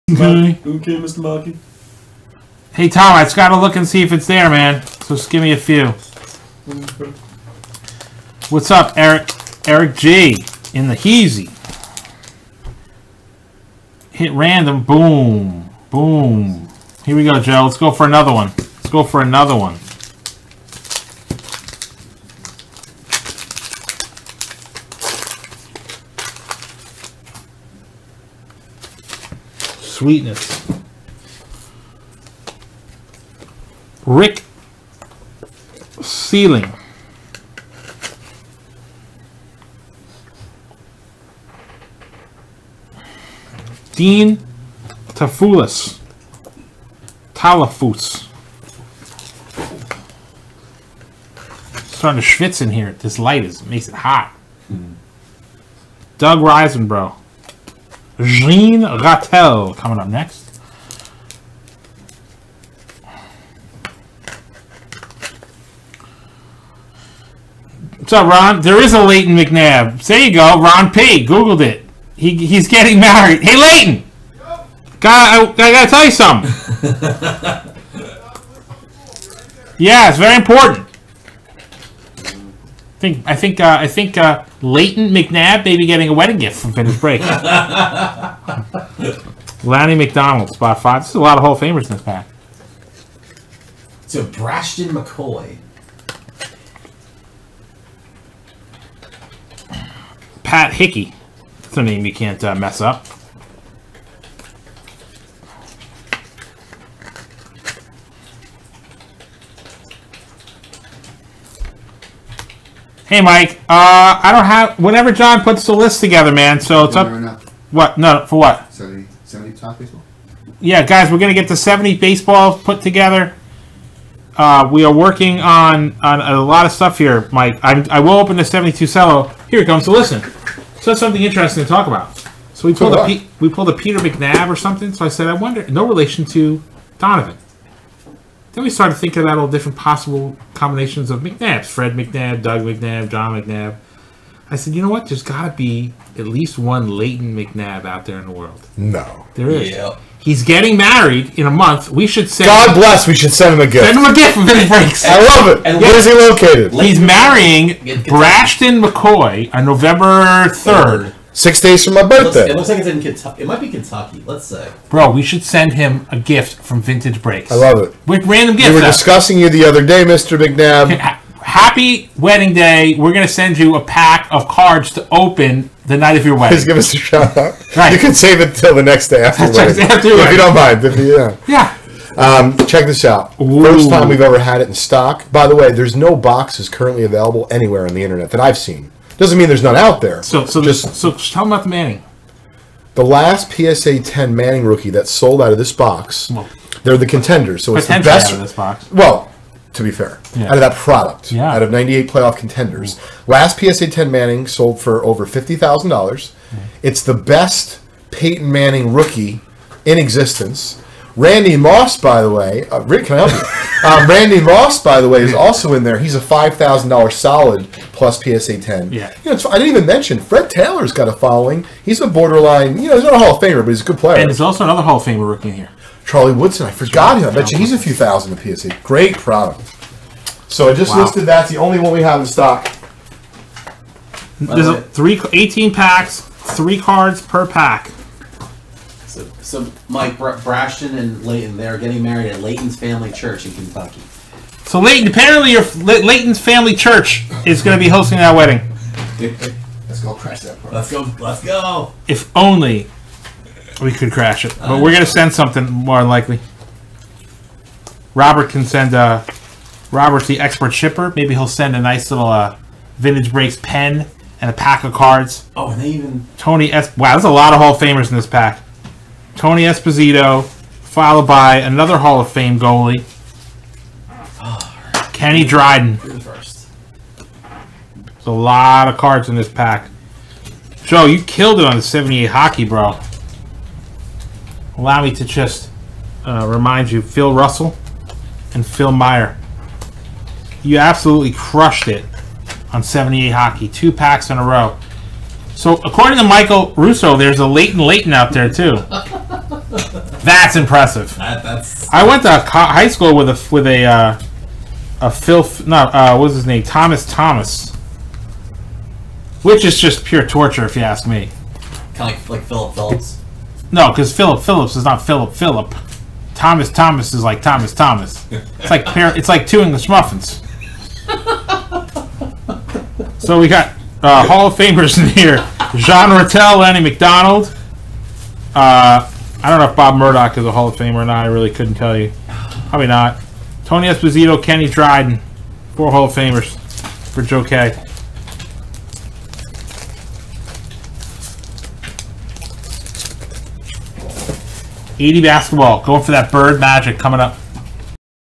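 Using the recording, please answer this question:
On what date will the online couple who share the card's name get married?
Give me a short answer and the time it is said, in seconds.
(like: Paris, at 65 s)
November 3, at 159 s.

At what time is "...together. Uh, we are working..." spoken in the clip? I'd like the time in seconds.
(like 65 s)
122 s.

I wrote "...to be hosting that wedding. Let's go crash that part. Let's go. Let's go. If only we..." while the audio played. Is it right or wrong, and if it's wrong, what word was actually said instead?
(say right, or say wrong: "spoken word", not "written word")
right.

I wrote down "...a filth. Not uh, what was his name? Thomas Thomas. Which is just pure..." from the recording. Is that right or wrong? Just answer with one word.
right.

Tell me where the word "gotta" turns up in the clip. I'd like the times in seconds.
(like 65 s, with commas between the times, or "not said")
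3 s, 75 s.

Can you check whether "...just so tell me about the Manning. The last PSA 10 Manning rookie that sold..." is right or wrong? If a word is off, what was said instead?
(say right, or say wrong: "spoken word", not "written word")
right.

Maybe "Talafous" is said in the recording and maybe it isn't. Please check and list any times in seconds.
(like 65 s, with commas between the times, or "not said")
47 s.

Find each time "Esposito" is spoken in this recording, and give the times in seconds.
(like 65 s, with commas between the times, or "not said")
269 s, 333 s.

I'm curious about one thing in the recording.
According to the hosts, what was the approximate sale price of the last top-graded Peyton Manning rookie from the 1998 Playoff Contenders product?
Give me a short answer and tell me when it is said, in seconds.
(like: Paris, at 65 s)
over $50,000, at 205 s.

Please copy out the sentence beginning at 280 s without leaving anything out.
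Joe, you killed it on the 78 hockey, bro.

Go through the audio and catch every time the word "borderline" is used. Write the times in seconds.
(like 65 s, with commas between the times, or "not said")
222 s.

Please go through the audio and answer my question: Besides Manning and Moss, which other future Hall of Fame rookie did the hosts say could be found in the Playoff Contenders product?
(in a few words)
Charlie Woodson.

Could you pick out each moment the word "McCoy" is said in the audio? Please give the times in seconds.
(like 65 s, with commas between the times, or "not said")
94 s, 158 s.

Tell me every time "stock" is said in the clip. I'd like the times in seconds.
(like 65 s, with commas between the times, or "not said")
184 s, 232 s.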